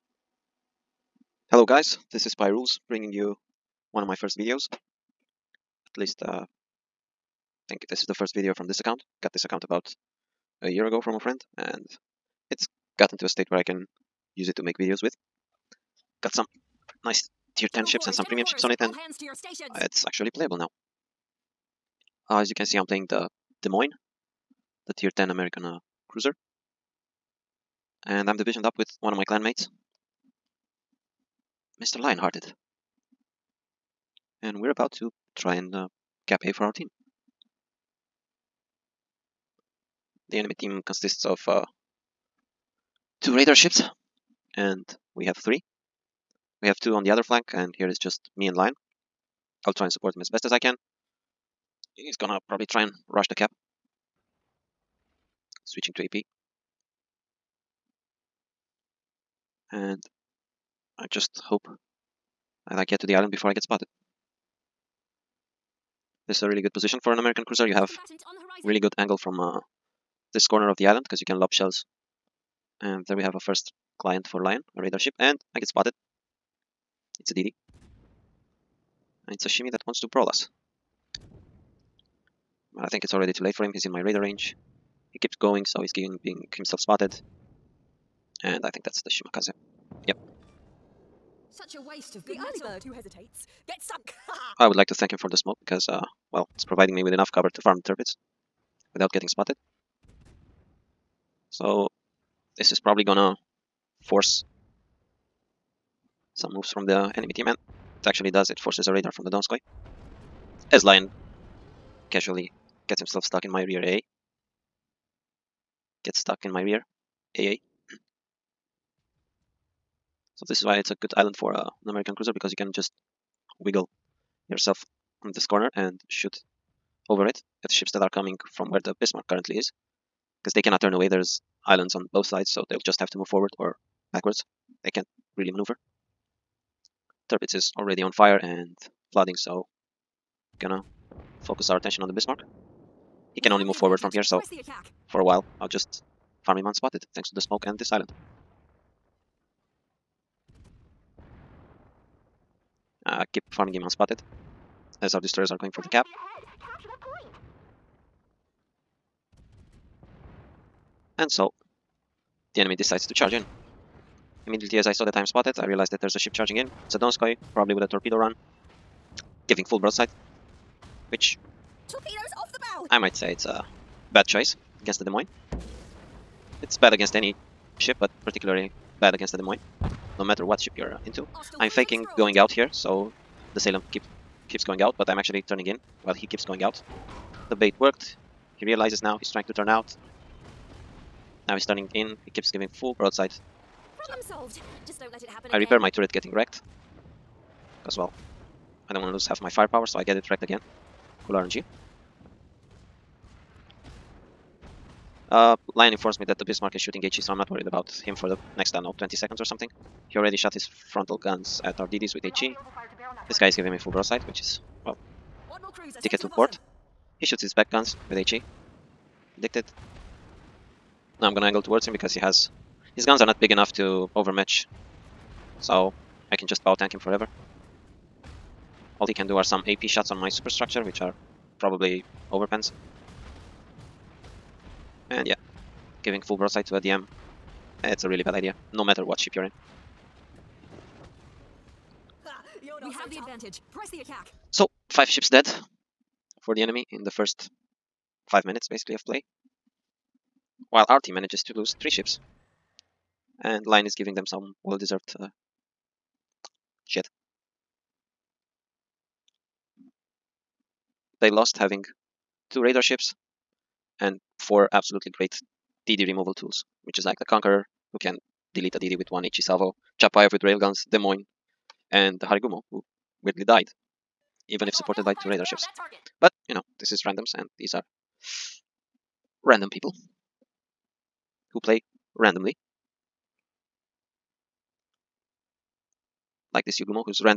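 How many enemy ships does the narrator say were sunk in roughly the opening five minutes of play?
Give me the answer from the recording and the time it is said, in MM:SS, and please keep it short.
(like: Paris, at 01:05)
5, at 04:04.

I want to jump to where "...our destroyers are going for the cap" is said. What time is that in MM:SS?
02:35.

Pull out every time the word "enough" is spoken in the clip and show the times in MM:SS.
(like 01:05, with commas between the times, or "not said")
01:37, 03:43.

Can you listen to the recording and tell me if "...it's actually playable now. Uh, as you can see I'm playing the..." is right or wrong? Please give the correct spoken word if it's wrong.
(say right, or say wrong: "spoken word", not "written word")
right.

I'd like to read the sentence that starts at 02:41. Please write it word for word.
And so the enemy decides to charge in.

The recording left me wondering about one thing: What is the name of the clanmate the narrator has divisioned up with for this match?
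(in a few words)
Mr. Lionhearted.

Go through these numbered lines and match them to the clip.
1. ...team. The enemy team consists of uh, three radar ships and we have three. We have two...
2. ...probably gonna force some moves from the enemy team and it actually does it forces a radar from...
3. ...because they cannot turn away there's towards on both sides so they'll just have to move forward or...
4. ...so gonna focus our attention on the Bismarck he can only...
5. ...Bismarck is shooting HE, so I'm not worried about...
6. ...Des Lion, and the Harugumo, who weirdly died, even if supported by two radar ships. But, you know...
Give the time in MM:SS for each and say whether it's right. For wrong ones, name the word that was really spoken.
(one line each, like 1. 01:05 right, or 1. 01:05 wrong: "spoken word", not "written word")
1. 00:36 wrong: "two", not "three"
2. 01:42 right
3. 02:10 wrong: "islands", not "towards"
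4. 02:19 right
5. 03:26 right
6. 04:30 wrong: "Moines", not "Lion".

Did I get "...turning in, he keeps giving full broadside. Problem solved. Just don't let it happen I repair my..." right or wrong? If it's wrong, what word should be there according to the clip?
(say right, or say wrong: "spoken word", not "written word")
right.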